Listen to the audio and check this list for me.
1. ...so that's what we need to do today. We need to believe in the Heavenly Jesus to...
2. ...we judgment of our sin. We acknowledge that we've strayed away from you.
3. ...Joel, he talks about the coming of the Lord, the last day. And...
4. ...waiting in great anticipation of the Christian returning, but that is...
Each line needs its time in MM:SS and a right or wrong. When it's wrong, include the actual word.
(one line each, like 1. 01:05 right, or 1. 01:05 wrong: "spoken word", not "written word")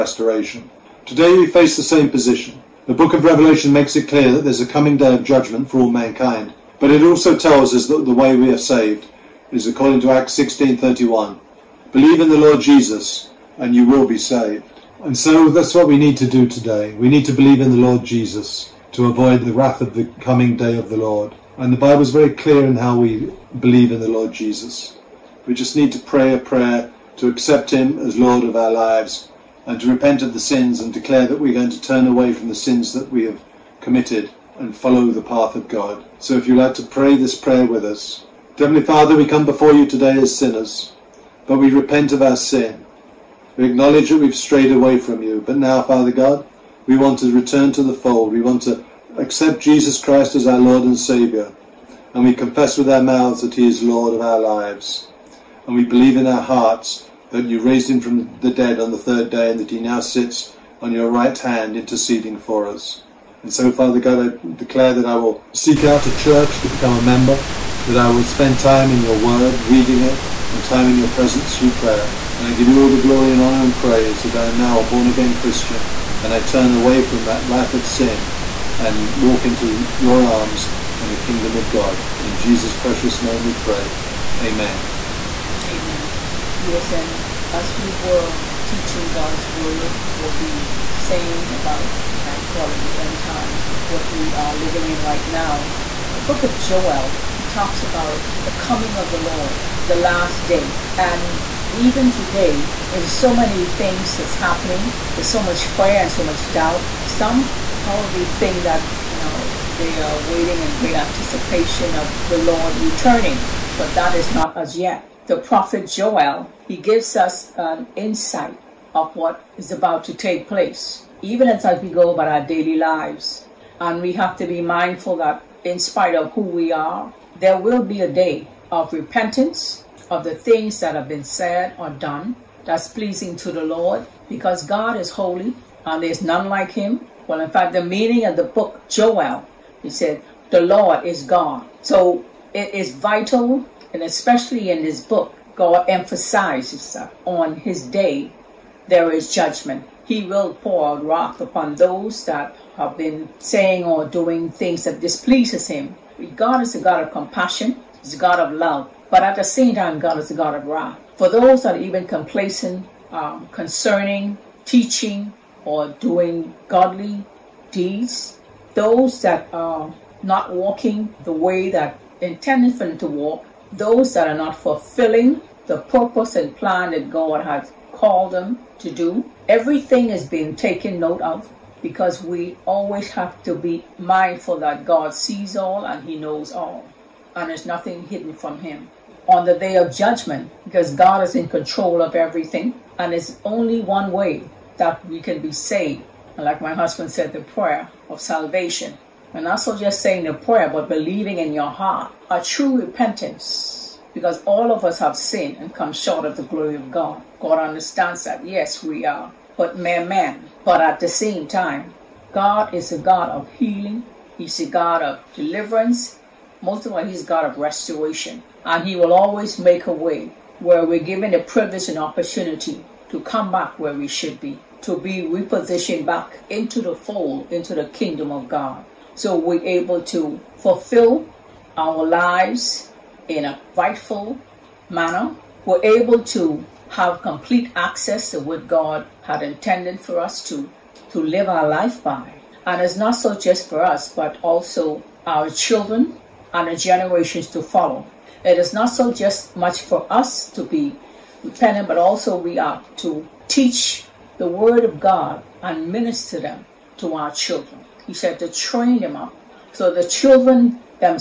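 1. 00:15 wrong: "Lord", not "Heavenly"
2. 00:41 wrong: "repent", not "judgment"
3. 01:36 right
4. 01:50 wrong: "Lord", not "Christian".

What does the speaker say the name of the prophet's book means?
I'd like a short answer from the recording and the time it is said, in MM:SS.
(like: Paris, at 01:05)
The Lord is God, at 02:20.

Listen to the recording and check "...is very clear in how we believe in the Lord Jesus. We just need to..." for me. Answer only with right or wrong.
right.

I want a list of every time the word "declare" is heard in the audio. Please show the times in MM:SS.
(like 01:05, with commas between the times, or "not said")
00:30, 01:04.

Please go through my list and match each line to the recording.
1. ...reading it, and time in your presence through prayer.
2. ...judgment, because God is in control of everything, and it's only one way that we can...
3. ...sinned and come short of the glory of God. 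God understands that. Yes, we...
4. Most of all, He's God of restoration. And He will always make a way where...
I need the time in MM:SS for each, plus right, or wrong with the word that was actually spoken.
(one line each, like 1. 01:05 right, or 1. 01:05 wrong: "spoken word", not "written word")
1. 01:09 right
2. 03:09 right
3. 03:25 right
4. 03:36 right.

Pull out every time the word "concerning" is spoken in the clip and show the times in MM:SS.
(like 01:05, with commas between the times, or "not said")
02:43.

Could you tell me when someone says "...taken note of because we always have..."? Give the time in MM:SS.
03:00.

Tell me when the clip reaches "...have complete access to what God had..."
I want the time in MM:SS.
03:56.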